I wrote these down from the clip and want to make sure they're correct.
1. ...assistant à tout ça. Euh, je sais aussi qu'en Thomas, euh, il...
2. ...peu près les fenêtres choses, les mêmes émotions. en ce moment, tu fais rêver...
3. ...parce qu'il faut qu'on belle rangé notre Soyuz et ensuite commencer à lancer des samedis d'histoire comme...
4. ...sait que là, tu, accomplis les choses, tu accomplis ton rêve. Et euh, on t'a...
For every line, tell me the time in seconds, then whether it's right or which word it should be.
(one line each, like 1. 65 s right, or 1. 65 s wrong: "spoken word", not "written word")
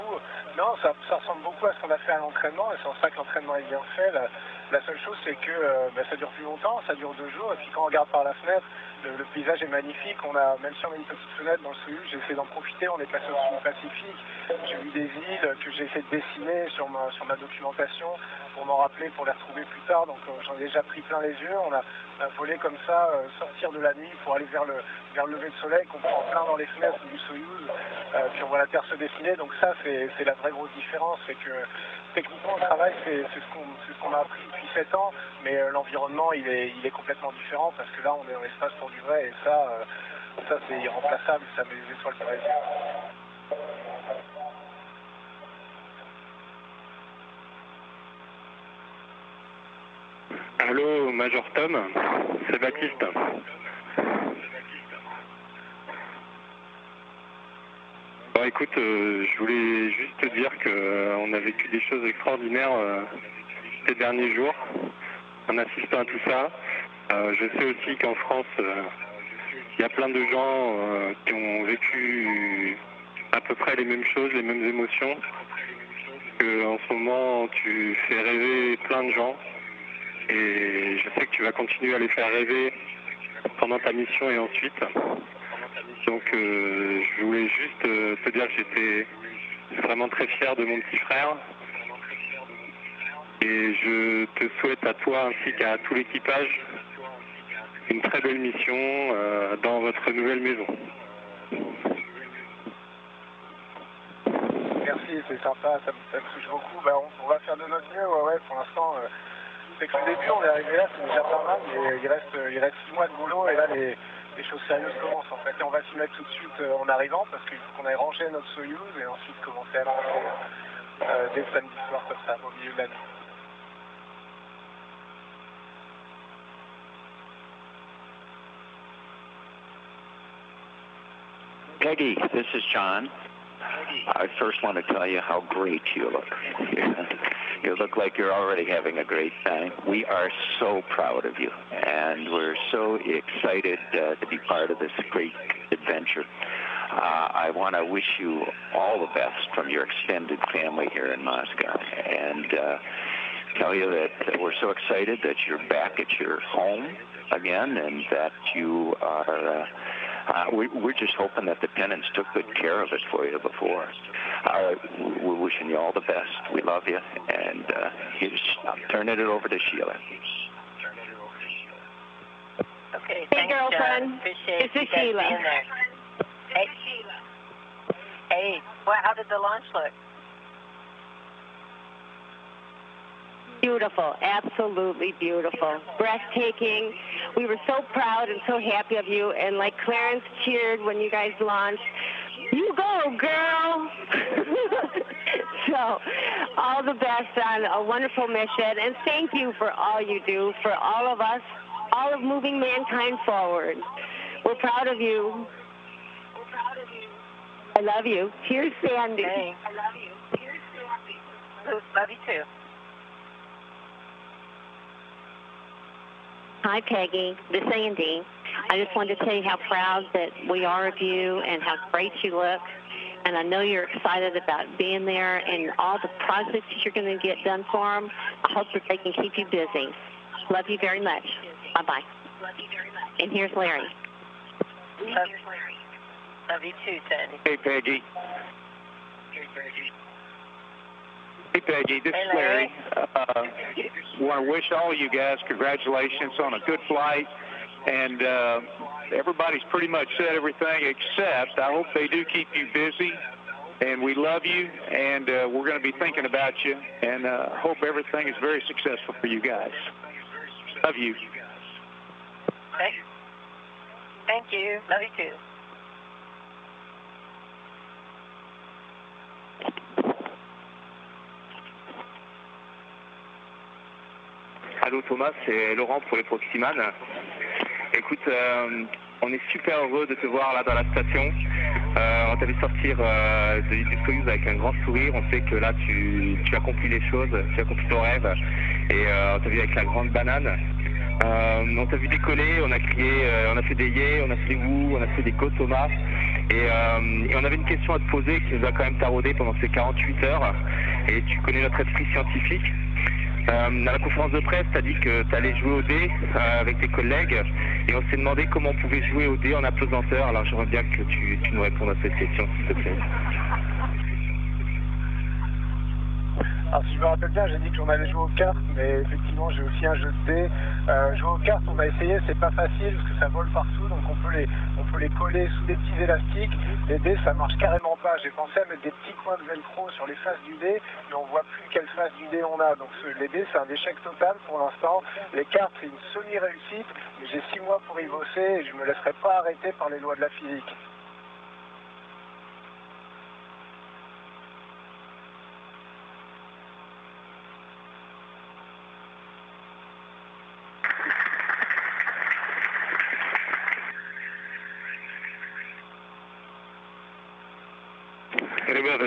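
1. 65 s wrong: "France", not "Thomas"
2. 73 s wrong: "mêmes", not "fenêtres"
3. 117 s wrong: "aille", not "belle"
4. 285 s right.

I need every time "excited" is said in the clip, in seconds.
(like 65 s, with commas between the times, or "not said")
142 s, 154 s, 223 s.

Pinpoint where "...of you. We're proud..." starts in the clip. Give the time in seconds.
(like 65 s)
204 s.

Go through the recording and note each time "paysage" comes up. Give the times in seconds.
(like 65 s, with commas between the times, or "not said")
9 s.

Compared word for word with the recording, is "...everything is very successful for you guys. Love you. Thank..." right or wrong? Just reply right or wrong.
right.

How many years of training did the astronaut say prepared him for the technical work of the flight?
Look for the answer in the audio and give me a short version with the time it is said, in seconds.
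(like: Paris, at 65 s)
7, at 34 s.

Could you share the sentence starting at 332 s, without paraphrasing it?
Donc, les dés, c'est un échec total pour l'instant.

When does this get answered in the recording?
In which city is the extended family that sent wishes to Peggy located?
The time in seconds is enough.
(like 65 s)
151 s.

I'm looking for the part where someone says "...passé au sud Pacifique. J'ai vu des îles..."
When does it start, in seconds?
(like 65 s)
13 s.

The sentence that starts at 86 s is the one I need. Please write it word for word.
Donc je voulais juste te dire que j'étais vraiment très fier de mon petit frère.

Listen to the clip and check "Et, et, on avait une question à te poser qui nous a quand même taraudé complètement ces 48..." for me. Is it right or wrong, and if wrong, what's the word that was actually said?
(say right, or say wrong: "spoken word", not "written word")
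wrong: "pendant", not "complètement".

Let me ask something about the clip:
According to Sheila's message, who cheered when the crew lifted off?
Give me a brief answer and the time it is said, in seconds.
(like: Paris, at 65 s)
Clarence, at 189 s.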